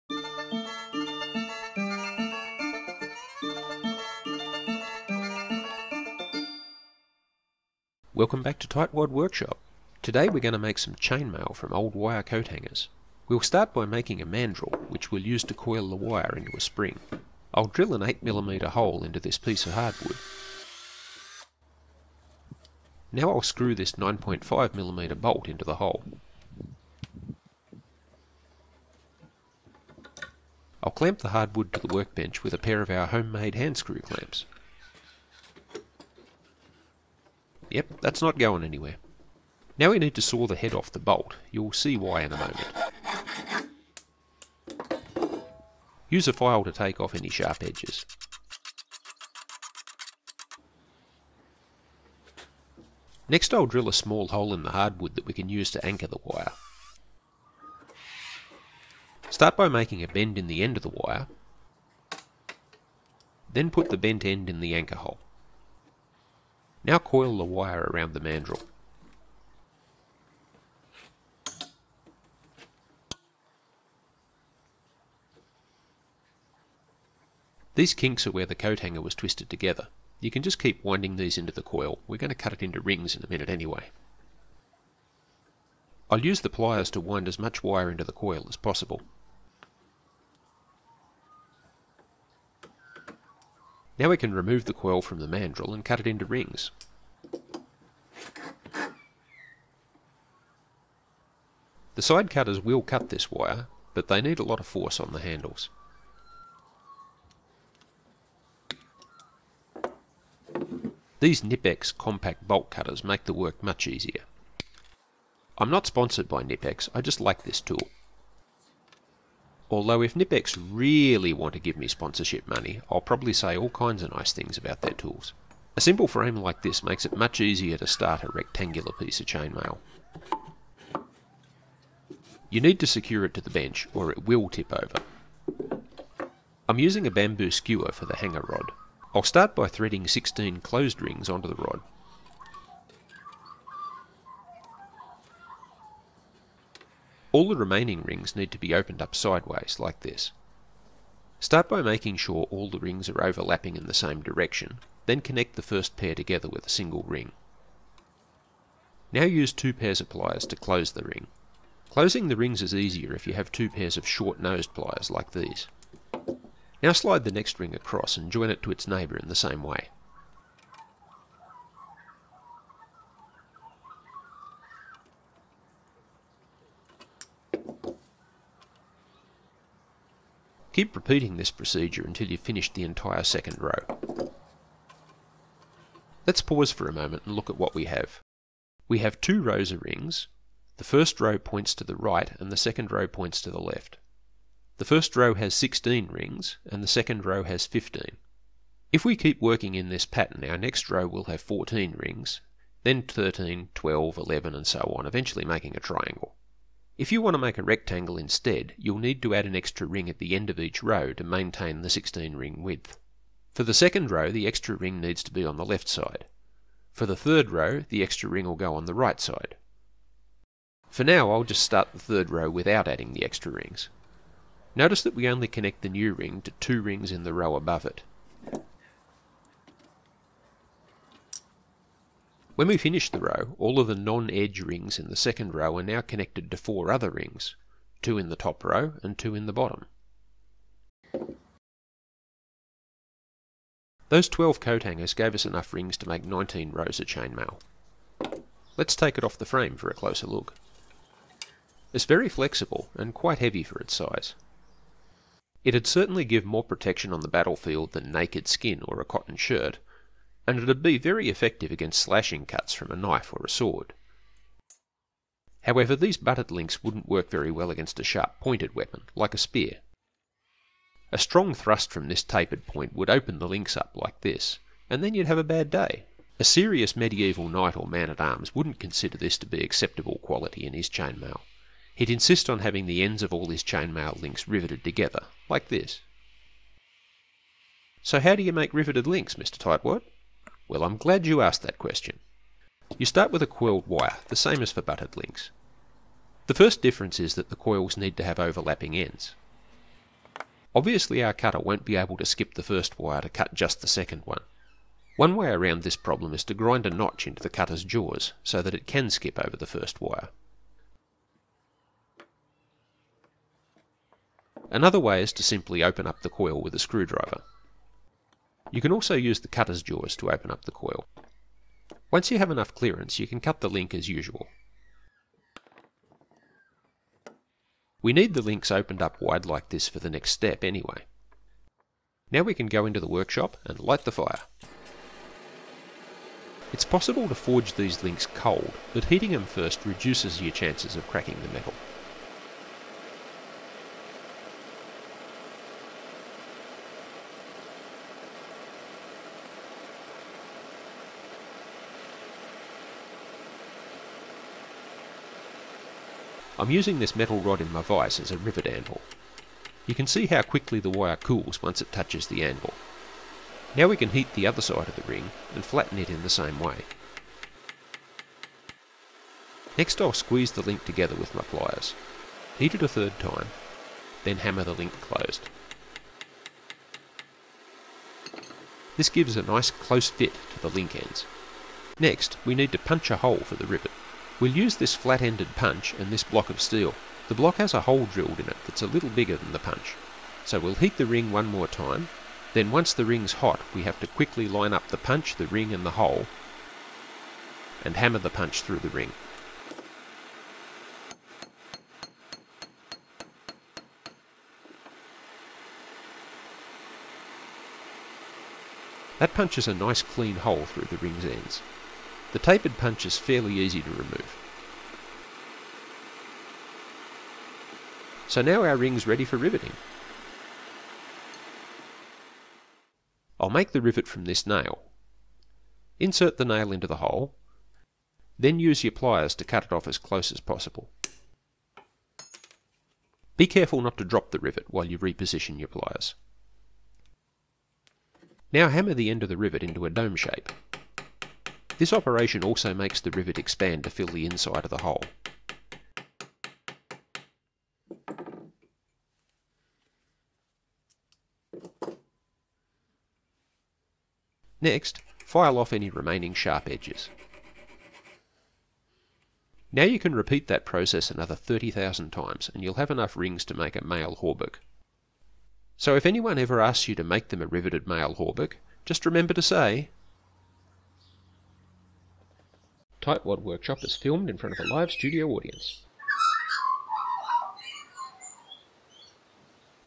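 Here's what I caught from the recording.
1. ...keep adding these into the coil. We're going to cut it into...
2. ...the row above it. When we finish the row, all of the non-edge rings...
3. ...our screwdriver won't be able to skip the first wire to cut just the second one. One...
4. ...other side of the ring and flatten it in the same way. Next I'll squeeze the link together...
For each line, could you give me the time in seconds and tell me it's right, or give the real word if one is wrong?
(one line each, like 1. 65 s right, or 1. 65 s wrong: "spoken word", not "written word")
1. 80 s wrong: "winding", not "adding"
2. 227 s right
3. 301 s wrong: "cutter", not "screwdriver"
4. 364 s right.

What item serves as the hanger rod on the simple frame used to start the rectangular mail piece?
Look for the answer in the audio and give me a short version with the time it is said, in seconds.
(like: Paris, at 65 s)
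bamboo skewer, at 137 s.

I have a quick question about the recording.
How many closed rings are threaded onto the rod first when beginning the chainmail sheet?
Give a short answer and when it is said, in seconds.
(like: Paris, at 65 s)
16, at 140 s.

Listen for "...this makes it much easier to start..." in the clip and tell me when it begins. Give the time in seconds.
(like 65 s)
126 s.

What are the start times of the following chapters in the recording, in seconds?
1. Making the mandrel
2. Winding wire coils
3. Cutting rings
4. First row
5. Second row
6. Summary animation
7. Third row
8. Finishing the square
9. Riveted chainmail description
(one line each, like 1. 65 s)
1. 13 s
2. 59 s
3. 101 s
4. 126 s
5. 151 s
6. 185 s
7. 221 s
8. 244 s
9. 276 s.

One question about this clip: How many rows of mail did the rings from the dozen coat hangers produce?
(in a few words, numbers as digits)
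19.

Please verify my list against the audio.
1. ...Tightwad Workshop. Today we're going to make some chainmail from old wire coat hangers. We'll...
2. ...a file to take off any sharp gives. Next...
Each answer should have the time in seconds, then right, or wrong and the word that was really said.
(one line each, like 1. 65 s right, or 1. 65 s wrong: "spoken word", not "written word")
1. 8 s right
2. 46 s wrong: "edges", not "gives".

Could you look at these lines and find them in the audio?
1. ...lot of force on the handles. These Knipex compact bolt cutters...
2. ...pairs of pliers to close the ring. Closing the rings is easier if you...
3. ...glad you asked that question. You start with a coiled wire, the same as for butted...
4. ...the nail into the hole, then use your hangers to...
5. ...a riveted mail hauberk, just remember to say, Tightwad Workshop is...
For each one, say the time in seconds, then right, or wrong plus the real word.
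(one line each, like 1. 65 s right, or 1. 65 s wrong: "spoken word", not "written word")
1. 104 s right
2. 159 s right
3. 290 s right
4. 426 s wrong: "pliers", not "hangers"
5. 467 s right.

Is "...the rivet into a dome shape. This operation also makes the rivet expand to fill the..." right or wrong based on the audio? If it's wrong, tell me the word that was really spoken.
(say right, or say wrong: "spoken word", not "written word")
right.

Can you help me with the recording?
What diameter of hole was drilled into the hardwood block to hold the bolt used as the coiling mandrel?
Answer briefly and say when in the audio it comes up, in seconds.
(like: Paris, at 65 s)
8mm, at 18 s.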